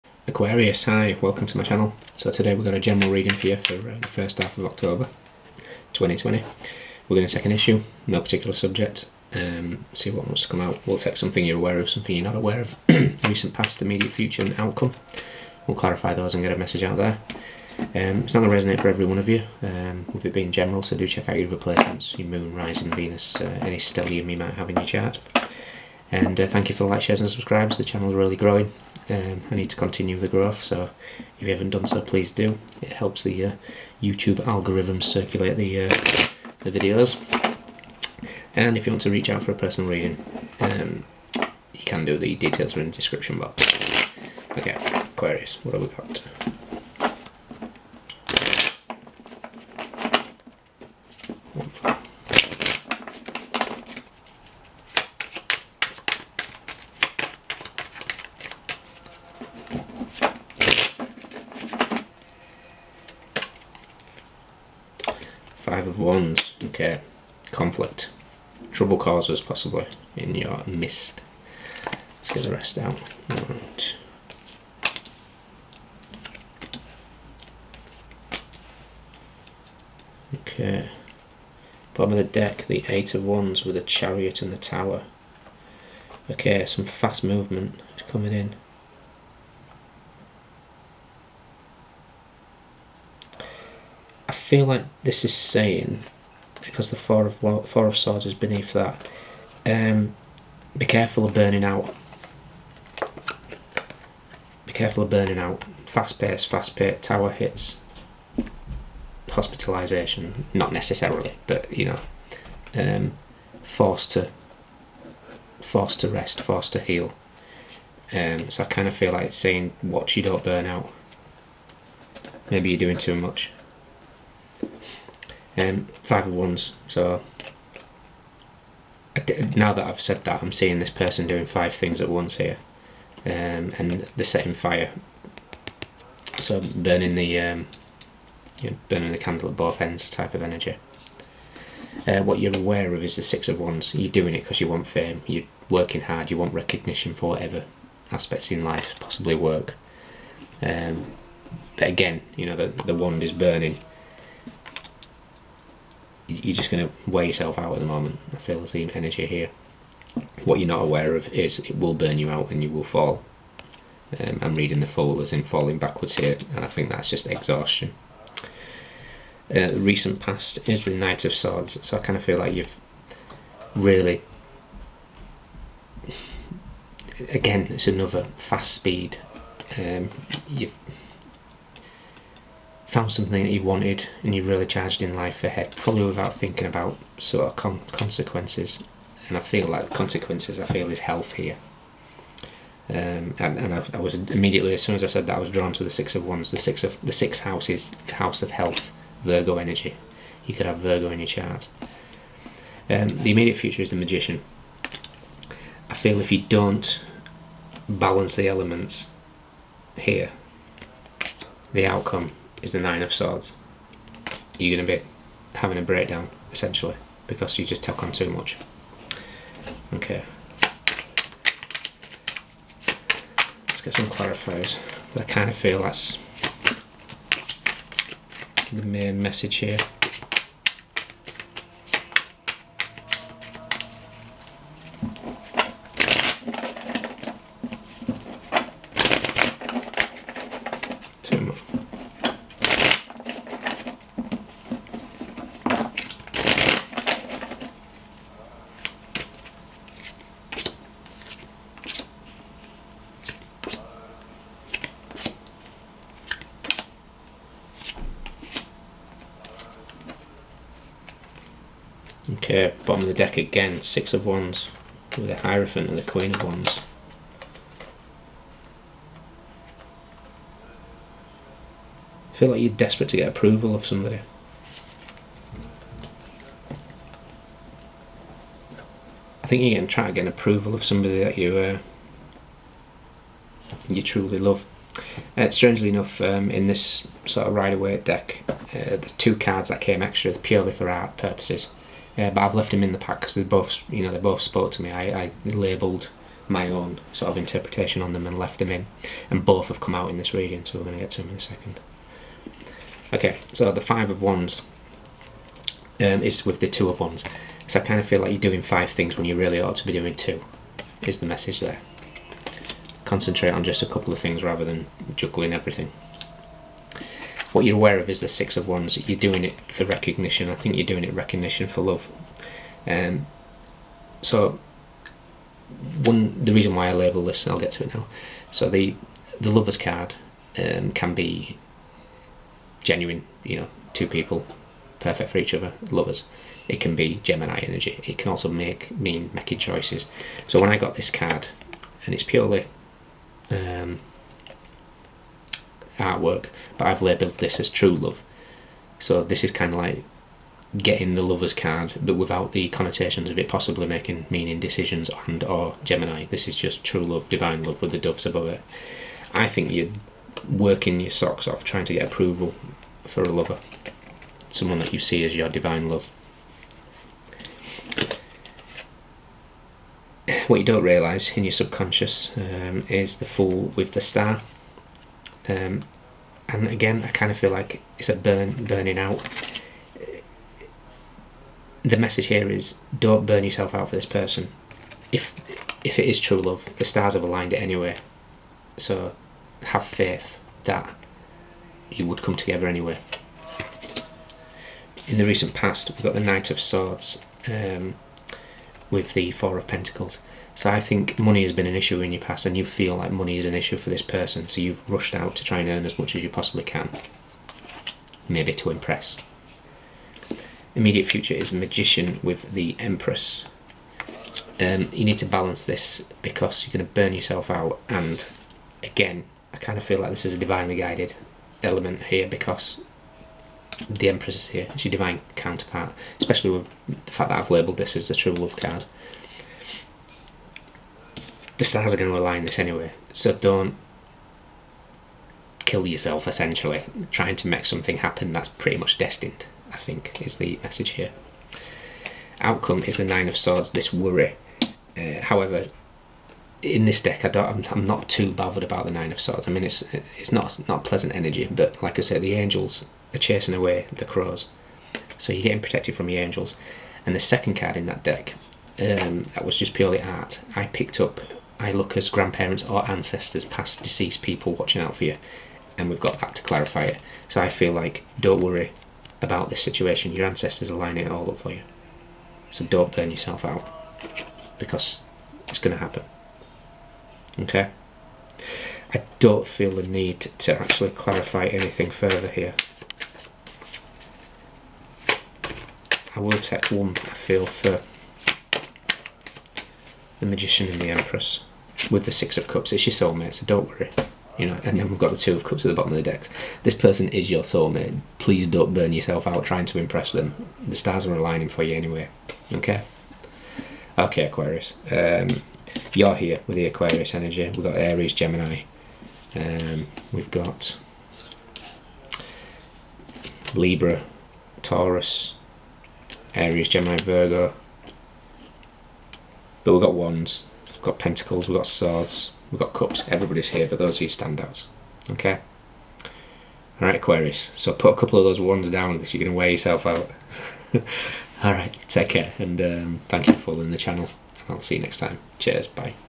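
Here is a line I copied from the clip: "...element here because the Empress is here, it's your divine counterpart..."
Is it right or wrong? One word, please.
right.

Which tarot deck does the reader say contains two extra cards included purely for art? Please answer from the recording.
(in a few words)
Rider-Waite.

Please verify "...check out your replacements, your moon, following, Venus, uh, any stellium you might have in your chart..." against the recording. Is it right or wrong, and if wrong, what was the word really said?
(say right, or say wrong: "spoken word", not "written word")
wrong: "rising", not "following".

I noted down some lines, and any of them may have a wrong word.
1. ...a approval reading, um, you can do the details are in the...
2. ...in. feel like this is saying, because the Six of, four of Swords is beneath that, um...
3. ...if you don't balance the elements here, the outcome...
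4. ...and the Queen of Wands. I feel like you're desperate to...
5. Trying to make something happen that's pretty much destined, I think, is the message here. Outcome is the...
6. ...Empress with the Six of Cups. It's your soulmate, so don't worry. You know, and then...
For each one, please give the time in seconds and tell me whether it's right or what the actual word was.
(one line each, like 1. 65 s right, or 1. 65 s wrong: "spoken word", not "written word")
1. 39 s wrong: "personal", not "approval"
2. 88 s wrong: "Four", not "Six"
3. 206 s right
4. 265 s right
5. 437 s right
6. 490 s right.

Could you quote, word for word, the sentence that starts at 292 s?
Uh, but I've left them in the pack because they both, you know, they both spoke to me.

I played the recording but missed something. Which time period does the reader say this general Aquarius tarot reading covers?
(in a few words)
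first half of October 2020.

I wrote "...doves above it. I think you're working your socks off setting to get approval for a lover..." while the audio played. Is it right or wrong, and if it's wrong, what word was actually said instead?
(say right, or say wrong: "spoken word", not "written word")
wrong: "trying", not "setting".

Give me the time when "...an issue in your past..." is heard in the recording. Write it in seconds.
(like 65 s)
401 s.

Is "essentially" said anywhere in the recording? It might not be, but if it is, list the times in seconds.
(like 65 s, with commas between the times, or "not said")
216 s, 436 s.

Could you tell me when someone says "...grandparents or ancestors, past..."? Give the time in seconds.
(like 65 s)
462 s.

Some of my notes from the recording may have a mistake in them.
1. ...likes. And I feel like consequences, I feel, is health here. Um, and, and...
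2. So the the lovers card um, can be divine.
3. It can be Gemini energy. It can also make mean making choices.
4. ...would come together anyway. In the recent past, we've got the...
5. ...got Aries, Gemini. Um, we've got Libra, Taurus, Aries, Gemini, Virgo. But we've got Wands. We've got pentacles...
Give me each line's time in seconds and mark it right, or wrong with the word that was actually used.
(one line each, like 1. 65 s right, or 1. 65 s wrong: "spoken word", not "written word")
1. 187 s wrong: "consequences", not "likes"
2. 328 s wrong: "genuine", not "divine"
3. 336 s right
4. 392 s right
5. 507 s right.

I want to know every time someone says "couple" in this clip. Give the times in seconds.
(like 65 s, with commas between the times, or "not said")
313 s, 527 s.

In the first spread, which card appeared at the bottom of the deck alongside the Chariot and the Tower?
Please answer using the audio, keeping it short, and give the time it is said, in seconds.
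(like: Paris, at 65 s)
Eight of Wands, at 82 s.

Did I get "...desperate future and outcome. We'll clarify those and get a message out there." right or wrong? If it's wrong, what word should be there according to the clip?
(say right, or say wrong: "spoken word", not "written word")
wrong: "immediate", not "desperate".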